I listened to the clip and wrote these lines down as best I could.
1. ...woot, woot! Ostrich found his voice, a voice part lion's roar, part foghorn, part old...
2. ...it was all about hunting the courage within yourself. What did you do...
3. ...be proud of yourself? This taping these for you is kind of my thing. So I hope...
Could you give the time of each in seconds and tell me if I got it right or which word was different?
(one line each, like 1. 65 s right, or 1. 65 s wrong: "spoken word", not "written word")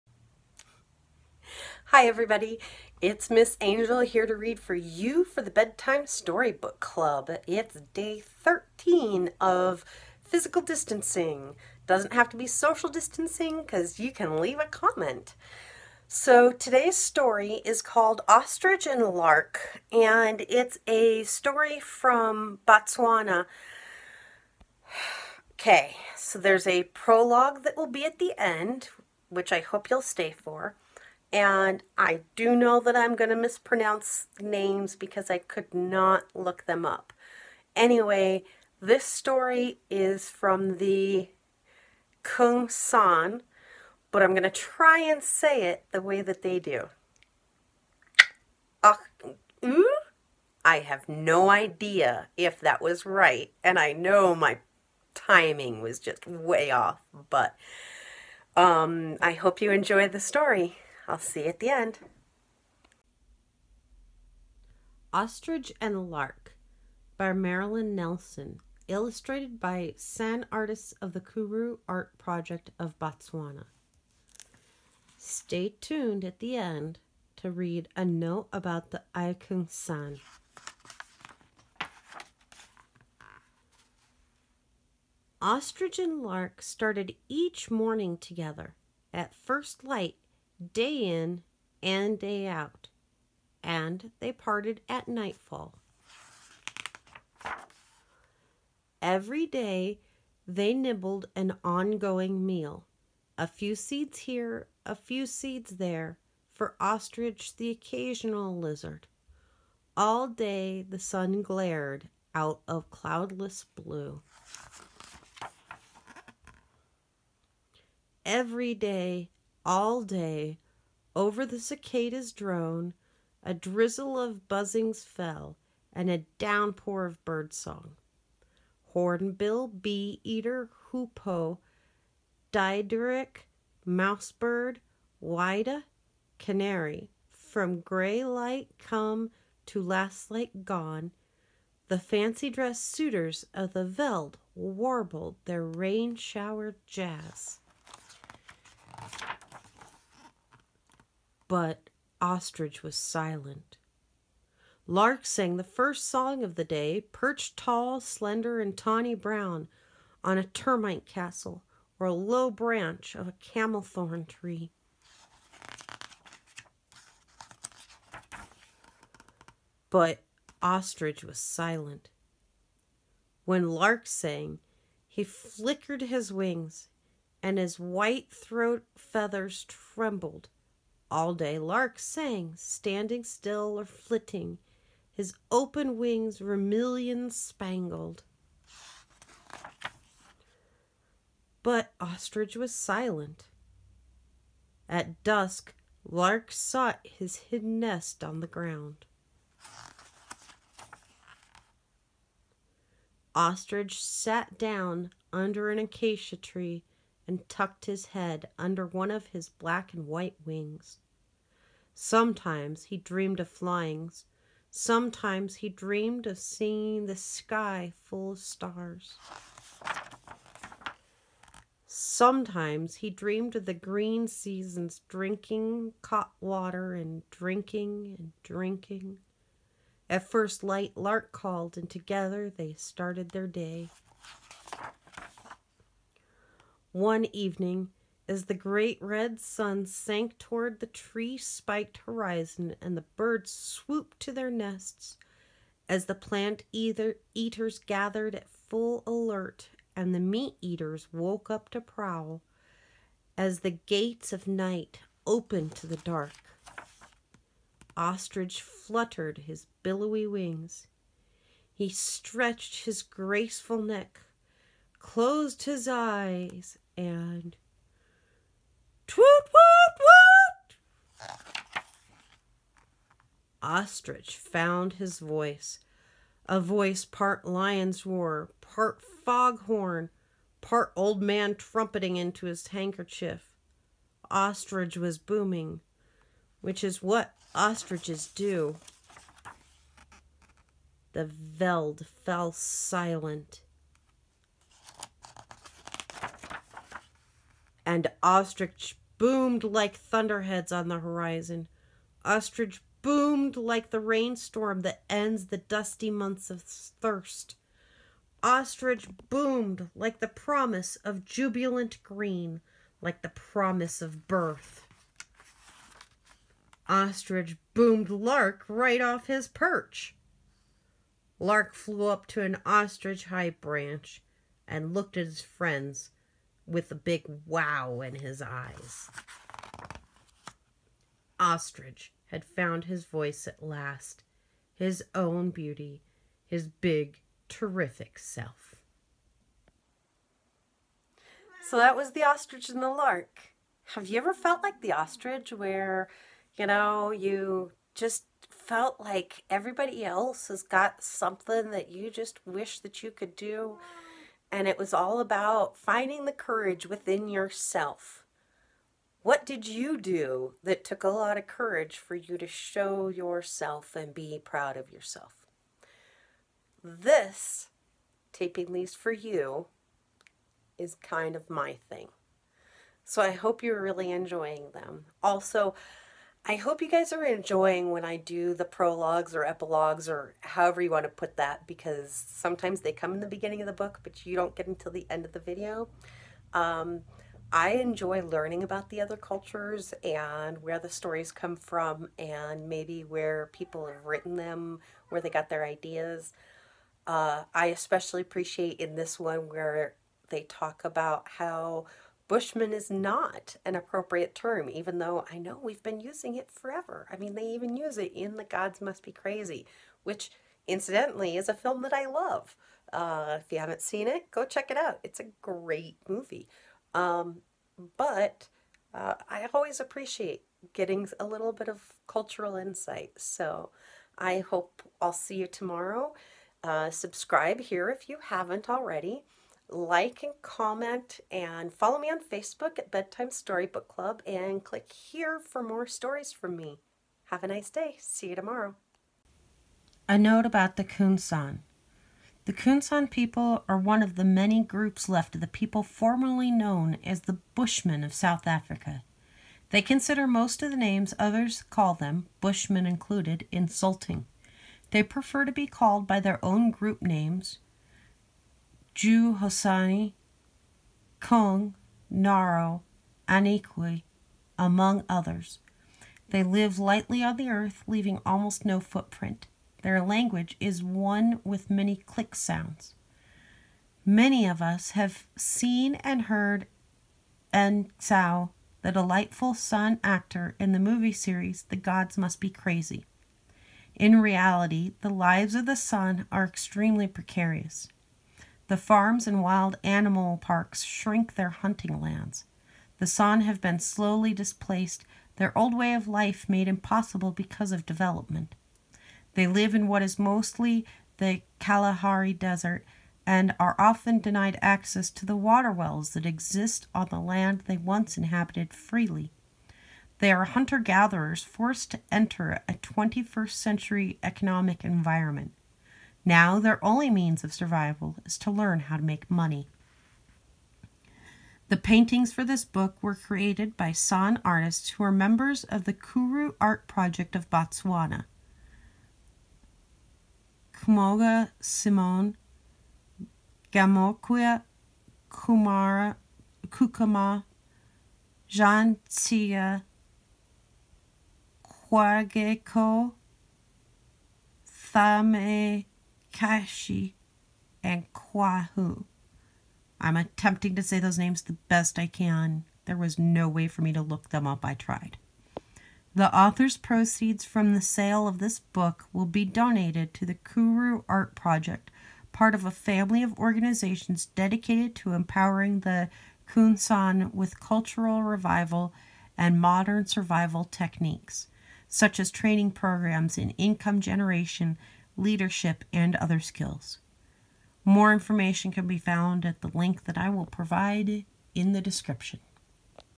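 1. 269 s right
2. 354 s wrong: "finding", not "hunting"
3. 364 s right.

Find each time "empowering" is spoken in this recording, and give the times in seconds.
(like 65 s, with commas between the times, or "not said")
565 s.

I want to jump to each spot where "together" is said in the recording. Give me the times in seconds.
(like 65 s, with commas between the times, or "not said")
88 s, 231 s.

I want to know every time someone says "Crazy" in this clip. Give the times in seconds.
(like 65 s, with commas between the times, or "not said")
409 s, 482 s.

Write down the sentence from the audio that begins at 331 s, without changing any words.
Ostrich had found his voice at last, his own beauty, his big, terrific self.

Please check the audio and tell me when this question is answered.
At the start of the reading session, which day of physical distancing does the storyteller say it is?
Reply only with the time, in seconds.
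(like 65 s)
7 s.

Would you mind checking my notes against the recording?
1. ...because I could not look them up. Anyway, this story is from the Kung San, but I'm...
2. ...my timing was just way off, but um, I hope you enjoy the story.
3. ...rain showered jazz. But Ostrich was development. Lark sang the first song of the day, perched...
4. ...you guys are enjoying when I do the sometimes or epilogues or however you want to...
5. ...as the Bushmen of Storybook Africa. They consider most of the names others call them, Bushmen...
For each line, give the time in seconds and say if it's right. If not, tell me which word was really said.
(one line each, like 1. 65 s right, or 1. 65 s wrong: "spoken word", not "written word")
1. 34 s right
2. 54 s right
3. 145 s wrong: "silent", not "development"
4. 376 s wrong: "prologues", not "sometimes"
5. 447 s wrong: "South", not "Storybook".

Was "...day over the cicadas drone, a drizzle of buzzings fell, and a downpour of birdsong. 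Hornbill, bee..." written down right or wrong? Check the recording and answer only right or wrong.
right.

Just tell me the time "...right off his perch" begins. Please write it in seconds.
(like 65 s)
318 s.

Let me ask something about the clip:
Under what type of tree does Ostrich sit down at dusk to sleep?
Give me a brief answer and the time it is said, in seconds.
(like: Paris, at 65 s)
acacia tree, at 205 s.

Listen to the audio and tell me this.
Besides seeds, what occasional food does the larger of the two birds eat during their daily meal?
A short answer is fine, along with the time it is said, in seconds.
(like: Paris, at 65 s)
lizard, at 108 s.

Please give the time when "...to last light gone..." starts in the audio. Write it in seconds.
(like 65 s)
139 s.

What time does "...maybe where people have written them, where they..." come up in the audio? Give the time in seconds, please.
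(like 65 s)
392 s.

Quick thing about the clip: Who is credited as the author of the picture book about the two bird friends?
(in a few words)
Marilyn Nelson.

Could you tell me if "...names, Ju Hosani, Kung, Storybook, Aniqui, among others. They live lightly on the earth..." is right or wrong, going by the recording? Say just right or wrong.
wrong.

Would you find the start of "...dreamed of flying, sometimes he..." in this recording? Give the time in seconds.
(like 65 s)
212 s.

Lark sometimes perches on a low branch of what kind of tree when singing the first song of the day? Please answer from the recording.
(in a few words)
camelthorn tree.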